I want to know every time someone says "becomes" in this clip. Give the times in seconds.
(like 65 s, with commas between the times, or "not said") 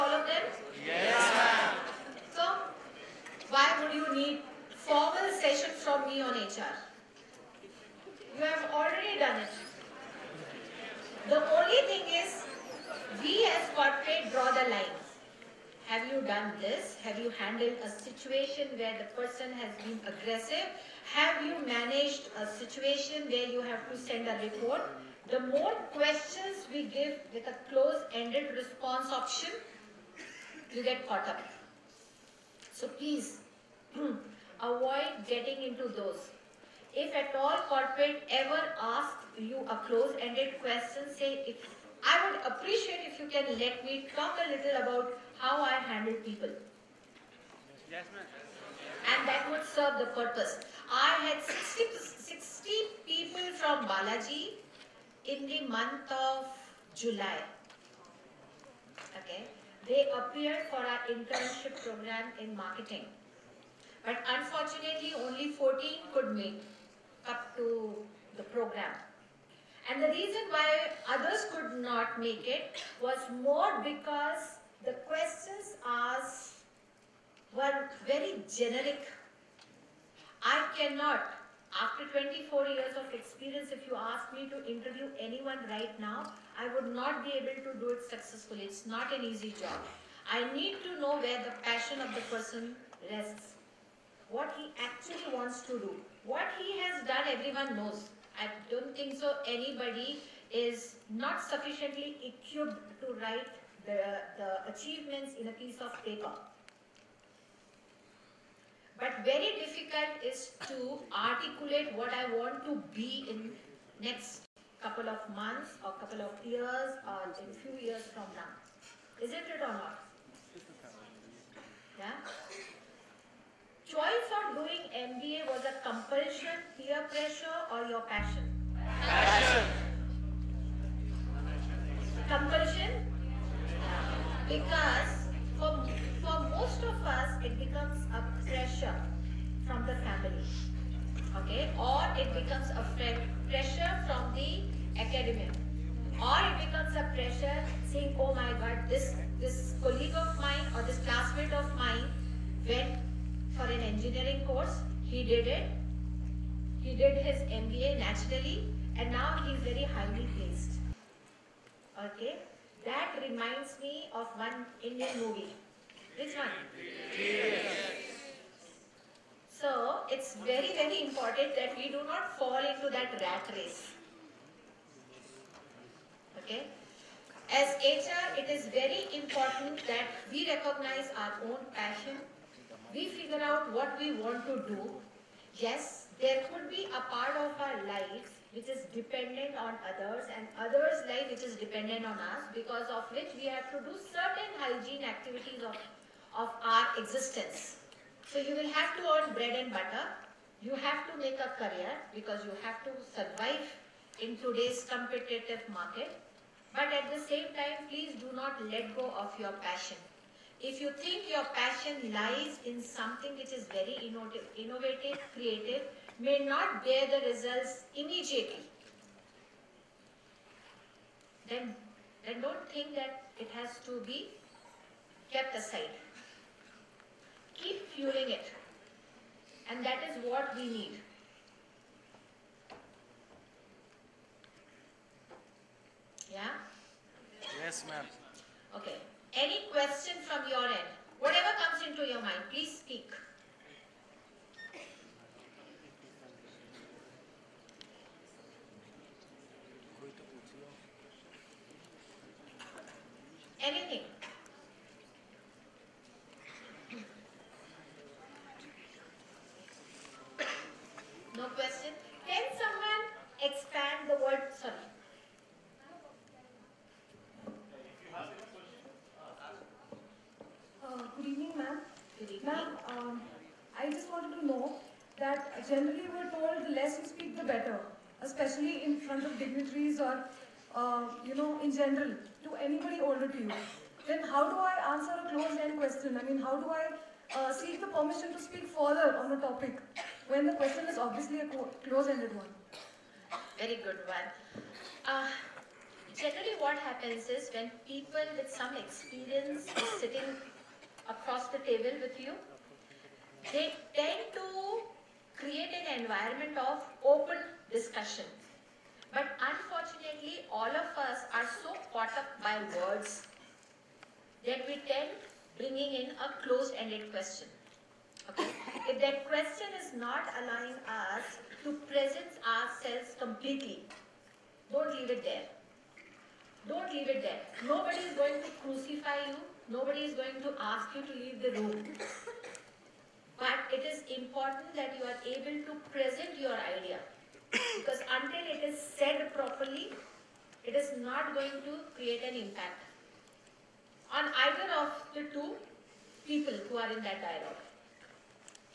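137 s, 142 s, 146 s.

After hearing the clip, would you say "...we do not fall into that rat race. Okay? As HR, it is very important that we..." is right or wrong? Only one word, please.
right.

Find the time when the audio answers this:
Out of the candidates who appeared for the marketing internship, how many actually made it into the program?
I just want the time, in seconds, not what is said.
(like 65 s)
65 s.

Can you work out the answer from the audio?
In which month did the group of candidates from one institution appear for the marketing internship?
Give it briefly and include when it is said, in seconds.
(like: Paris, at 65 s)
July, at 56 s.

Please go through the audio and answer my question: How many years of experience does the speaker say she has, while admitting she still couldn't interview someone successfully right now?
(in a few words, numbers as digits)
24.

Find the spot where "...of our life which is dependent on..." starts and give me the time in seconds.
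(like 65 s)
187 s.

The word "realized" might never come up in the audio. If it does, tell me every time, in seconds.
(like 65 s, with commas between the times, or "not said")
not said.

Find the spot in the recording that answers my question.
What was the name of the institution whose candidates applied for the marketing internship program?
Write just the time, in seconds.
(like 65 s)
53 s.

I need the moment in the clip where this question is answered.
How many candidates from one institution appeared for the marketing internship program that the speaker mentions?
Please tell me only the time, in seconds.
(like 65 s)
52 s.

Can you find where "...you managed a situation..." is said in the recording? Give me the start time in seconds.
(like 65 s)
21 s.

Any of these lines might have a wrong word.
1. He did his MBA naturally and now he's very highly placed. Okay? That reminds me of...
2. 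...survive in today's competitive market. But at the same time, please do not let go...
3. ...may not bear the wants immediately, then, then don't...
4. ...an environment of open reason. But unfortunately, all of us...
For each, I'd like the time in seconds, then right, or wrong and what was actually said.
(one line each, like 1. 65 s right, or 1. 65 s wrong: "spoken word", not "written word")
1. 156 s right
2. 203 s right
3. 216 s wrong: "results", not "wants"
4. 305 s wrong: "discussion", not "reason".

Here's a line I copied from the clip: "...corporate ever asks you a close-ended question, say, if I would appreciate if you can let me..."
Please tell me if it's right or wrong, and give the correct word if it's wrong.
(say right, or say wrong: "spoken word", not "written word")
right.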